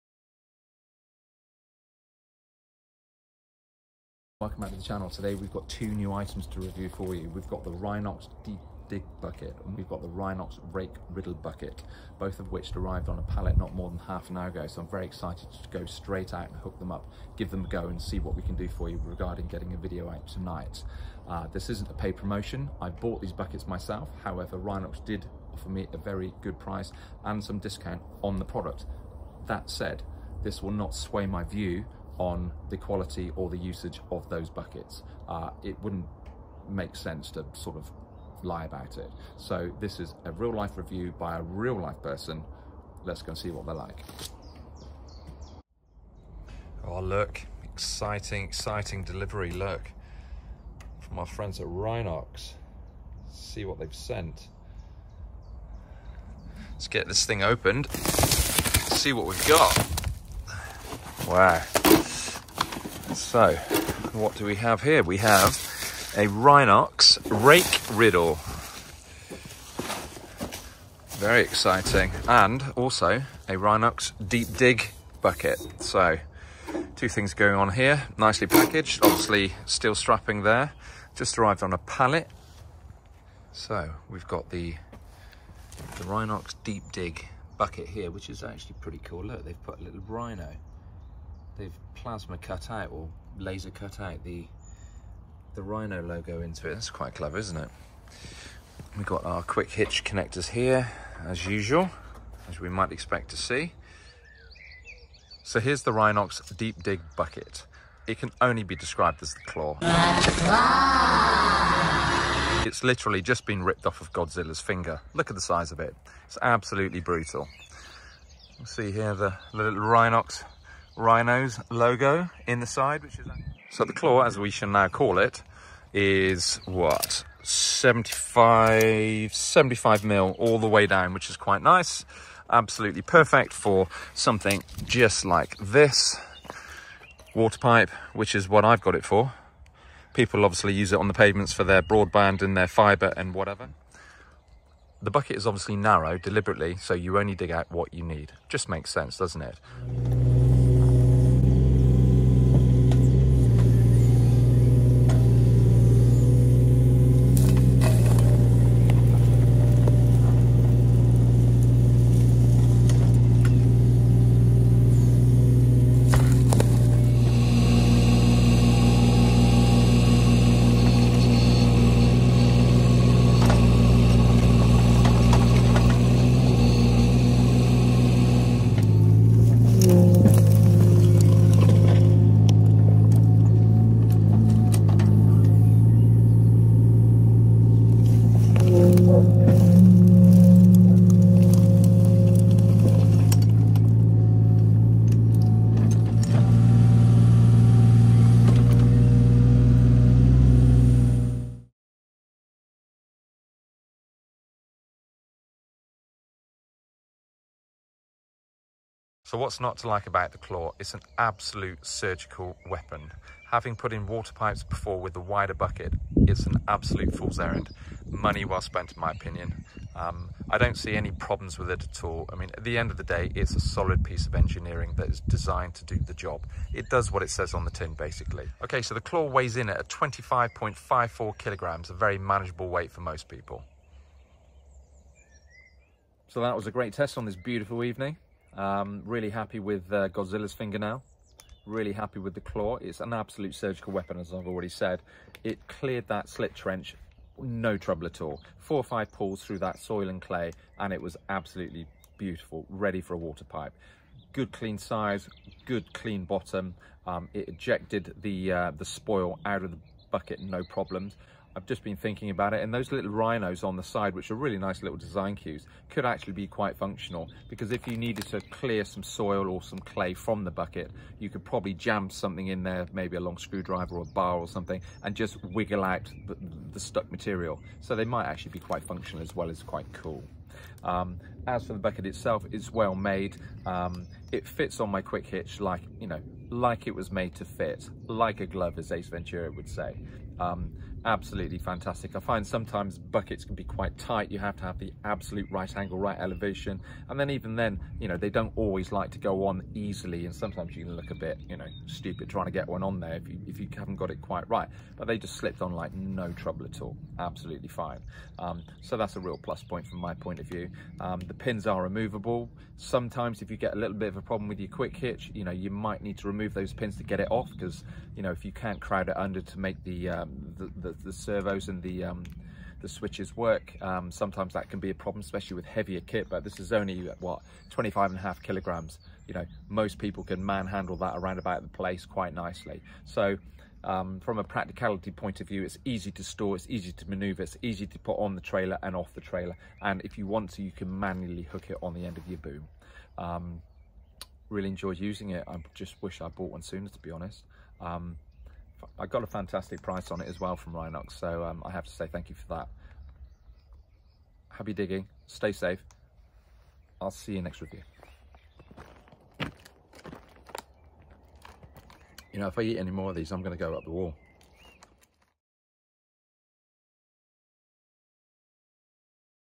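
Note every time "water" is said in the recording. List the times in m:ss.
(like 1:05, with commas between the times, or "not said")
2:17, 3:34, 4:13.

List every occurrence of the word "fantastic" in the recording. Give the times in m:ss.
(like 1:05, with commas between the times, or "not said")
4:51, 5:49.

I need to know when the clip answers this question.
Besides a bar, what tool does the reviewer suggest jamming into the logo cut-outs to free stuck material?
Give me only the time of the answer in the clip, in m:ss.
4:33.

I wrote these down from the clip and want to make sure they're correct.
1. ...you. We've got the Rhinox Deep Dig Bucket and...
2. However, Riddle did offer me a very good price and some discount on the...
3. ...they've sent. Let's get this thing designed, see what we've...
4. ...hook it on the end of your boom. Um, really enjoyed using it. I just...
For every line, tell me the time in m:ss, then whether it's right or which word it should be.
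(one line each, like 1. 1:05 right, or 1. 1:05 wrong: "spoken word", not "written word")
1. 0:07 right
2. 0:24 wrong: "Rhinox", not "Riddle"
3. 0:53 wrong: "opened", not "designed"
4. 5:41 right.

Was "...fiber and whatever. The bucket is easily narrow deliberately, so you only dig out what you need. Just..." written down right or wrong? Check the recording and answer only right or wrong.
wrong.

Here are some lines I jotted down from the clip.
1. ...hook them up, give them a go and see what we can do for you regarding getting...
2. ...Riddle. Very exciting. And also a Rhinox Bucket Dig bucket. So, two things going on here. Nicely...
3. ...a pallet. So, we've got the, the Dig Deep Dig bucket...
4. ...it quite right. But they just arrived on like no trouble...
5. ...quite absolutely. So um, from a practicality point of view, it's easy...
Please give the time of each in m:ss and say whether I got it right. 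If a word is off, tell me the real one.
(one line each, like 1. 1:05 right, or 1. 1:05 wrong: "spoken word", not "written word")
1. 0:16 right
2. 1:07 wrong: "Deep", not "Bucket"
3. 1:21 wrong: "Rhinox", not "Dig"
4. 5:04 wrong: "slipped", not "arrived"
5. 5:32 wrong: "nicely", not "absolutely".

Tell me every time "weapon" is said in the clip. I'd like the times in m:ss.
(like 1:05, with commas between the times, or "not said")
3:32, 4:03.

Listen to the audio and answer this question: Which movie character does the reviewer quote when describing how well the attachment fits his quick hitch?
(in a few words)
Ace Ventura.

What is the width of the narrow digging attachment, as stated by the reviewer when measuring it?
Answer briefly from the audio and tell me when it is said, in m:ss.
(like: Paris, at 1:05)
75 mil, at 2:09.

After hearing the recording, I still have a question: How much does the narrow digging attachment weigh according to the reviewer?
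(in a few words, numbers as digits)
25.54 kilograms.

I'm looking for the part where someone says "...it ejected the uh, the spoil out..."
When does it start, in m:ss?
4:17.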